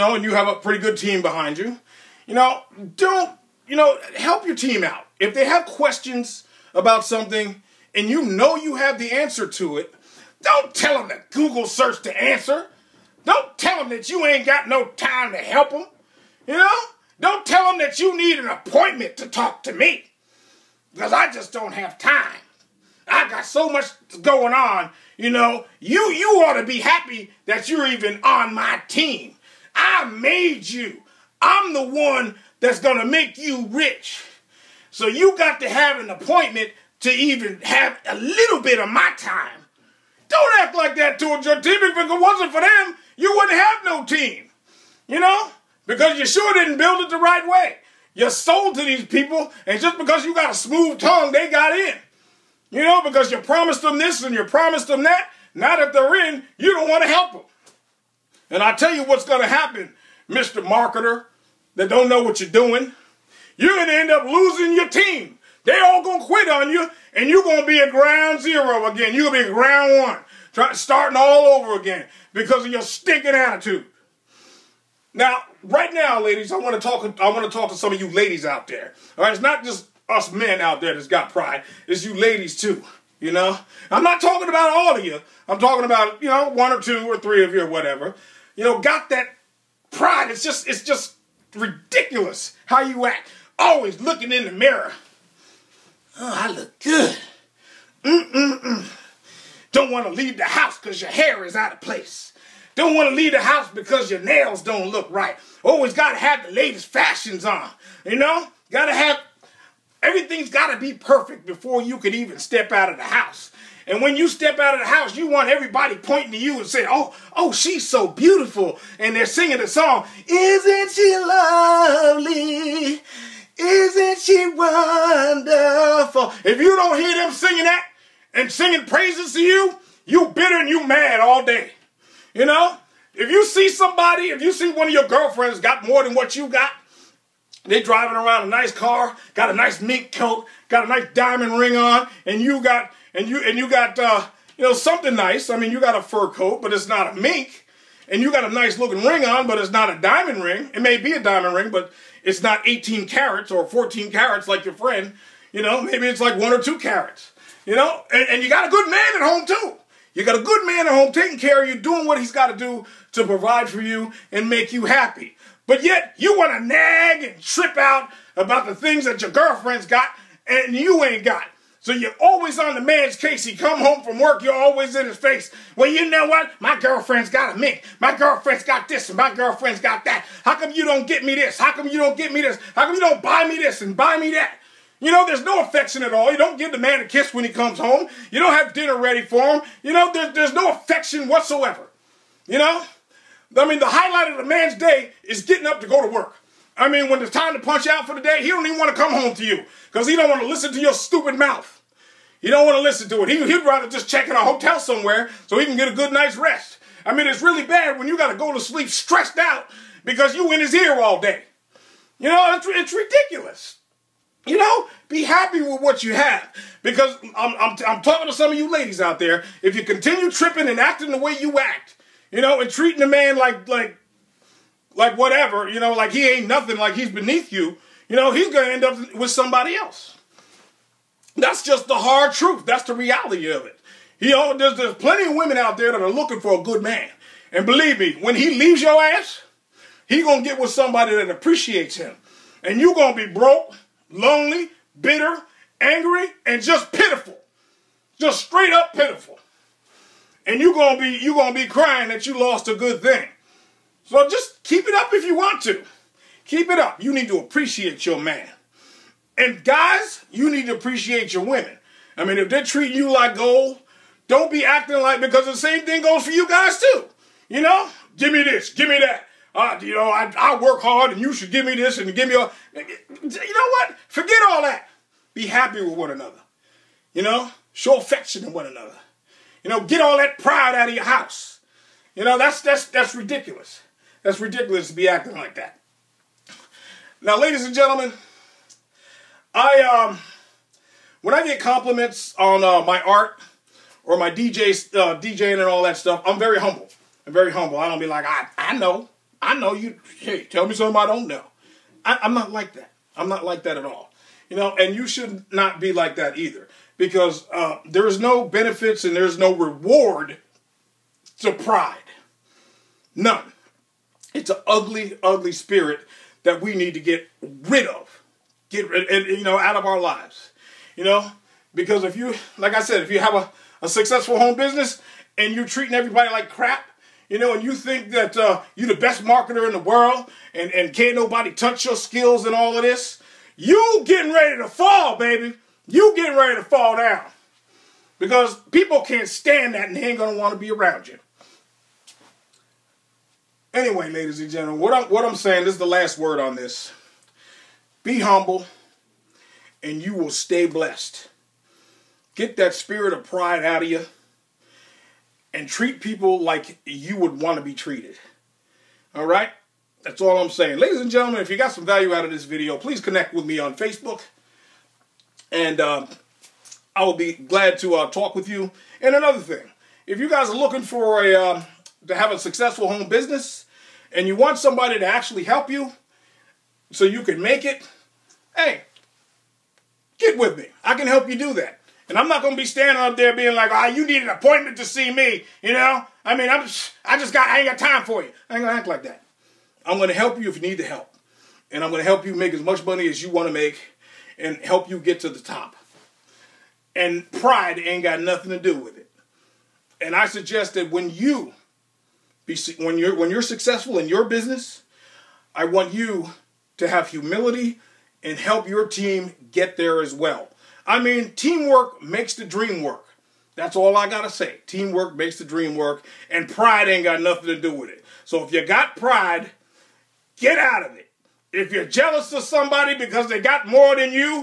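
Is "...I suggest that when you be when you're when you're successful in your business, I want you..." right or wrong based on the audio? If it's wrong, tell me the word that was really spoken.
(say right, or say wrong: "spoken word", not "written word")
right.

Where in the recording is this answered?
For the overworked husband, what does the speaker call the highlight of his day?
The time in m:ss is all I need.
3:15.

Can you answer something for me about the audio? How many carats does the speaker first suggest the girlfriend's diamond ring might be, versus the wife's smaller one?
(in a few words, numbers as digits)
18.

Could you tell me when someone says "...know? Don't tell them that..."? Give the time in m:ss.
0:16.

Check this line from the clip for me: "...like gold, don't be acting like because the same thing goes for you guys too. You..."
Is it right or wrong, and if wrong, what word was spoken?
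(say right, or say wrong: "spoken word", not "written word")
right.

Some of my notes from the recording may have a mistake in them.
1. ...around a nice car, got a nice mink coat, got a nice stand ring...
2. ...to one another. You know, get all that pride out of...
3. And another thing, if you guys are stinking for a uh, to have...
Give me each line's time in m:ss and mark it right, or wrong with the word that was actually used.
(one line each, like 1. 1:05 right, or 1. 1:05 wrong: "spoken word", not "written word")
1. 2:18 wrong: "diamond", not "stand"
2. 4:38 right
3. 6:09 wrong: "looking", not "stinking".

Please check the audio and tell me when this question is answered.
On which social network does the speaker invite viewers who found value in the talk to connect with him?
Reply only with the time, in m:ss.
6:03.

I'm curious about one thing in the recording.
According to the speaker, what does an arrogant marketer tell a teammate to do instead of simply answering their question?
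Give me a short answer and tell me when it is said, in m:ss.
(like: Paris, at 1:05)
Google search the answer, at 0:11.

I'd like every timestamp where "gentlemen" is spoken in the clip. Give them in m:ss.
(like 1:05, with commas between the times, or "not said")
4:47, 5:44, 6:01.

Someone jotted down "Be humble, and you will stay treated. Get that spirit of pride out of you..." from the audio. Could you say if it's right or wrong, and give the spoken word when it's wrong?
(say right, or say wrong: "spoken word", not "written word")
wrong: "blessed", not "treated".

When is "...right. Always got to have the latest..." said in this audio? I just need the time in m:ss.
1:45.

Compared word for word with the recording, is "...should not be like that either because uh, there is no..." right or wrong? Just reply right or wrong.
right.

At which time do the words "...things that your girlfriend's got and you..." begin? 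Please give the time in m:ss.
2:48.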